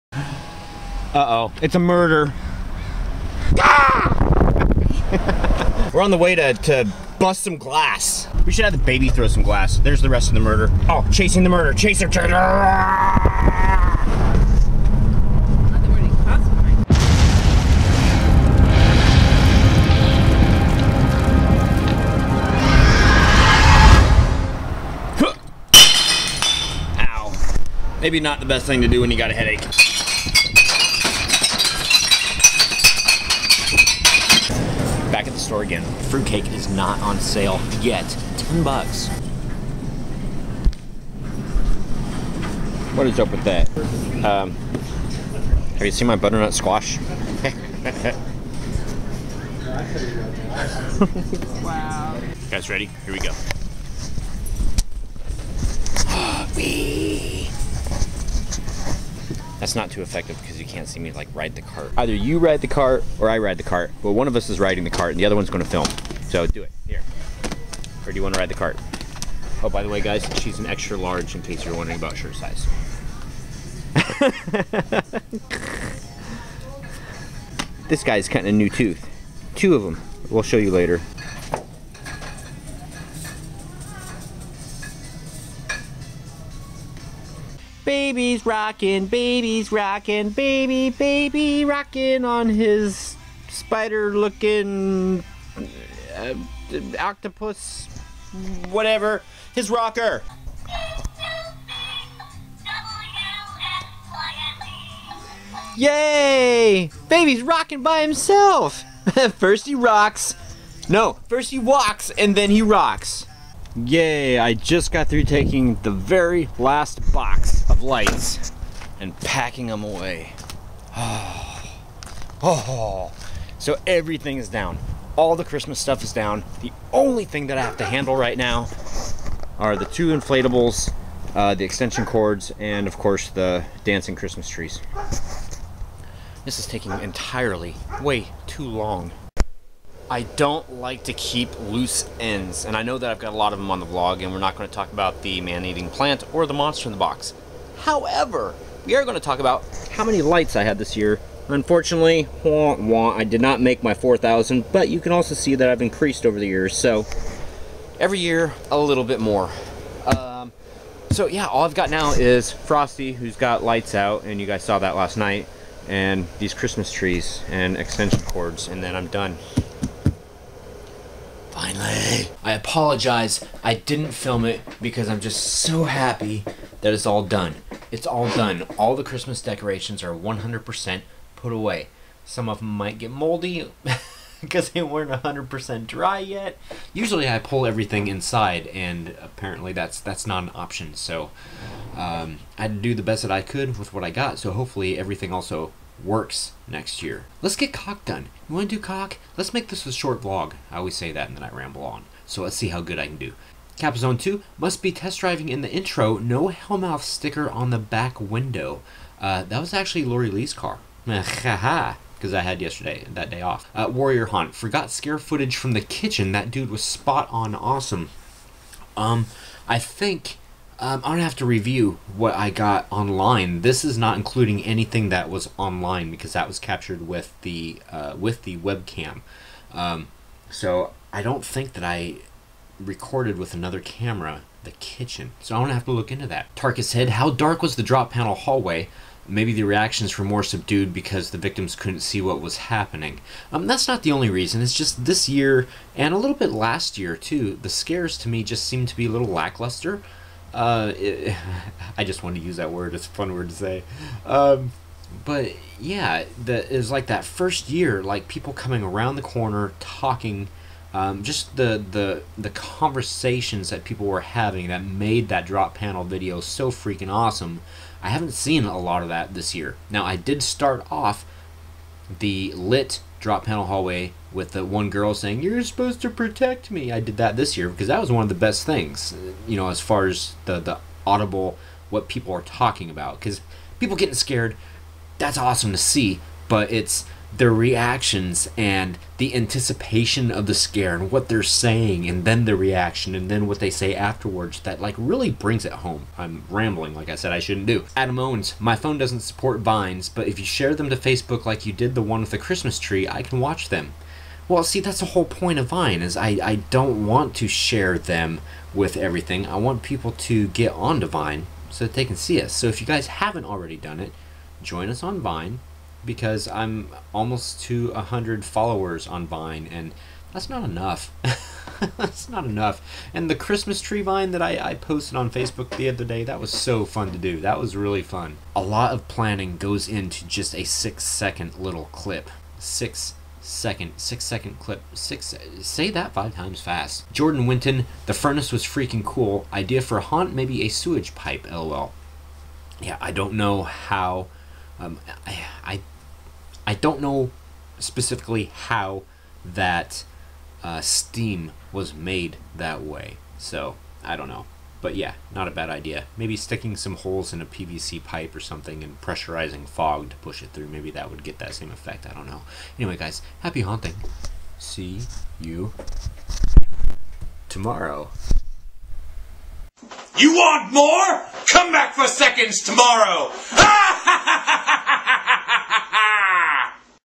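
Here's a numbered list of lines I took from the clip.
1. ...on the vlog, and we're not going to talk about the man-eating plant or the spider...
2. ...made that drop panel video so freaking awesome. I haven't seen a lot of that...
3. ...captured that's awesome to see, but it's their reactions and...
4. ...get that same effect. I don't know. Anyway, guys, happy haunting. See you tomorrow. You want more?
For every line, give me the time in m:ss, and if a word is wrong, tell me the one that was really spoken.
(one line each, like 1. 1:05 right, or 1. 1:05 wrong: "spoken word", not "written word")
1. 2:23 wrong: "monster", not "spider"
2. 4:24 right
3. 4:44 wrong: "scared", not "captured"
4. 6:01 right.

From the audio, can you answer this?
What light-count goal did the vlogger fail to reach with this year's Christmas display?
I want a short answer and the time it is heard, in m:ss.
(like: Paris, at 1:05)
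4,000, at 2:33.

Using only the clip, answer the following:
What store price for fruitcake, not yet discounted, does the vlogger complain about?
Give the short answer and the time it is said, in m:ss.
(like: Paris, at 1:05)
$10, at 0:38.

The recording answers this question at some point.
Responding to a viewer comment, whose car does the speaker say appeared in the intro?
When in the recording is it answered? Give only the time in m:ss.
3:30.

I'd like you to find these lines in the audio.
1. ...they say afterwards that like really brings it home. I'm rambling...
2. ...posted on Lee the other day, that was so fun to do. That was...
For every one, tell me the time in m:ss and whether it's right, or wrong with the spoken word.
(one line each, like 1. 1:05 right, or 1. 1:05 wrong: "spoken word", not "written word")
1. 4:53 right
2. 5:24 wrong: "Facebook", not "Lee".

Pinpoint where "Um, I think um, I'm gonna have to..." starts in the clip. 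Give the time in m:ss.
3:38.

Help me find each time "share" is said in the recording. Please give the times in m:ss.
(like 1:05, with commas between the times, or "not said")
5:00, 5:07.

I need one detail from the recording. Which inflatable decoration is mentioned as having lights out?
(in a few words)
Frosty.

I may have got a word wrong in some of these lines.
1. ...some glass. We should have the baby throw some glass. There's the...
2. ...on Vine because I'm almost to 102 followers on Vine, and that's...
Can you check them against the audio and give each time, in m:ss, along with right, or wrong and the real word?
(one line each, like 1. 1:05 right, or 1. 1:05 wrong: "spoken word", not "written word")
1. 0:07 right
2. 5:15 wrong: "100", not "102".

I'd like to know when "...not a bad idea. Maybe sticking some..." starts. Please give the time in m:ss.
5:55.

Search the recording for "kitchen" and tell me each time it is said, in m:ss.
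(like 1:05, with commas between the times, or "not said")
3:35, 3:54.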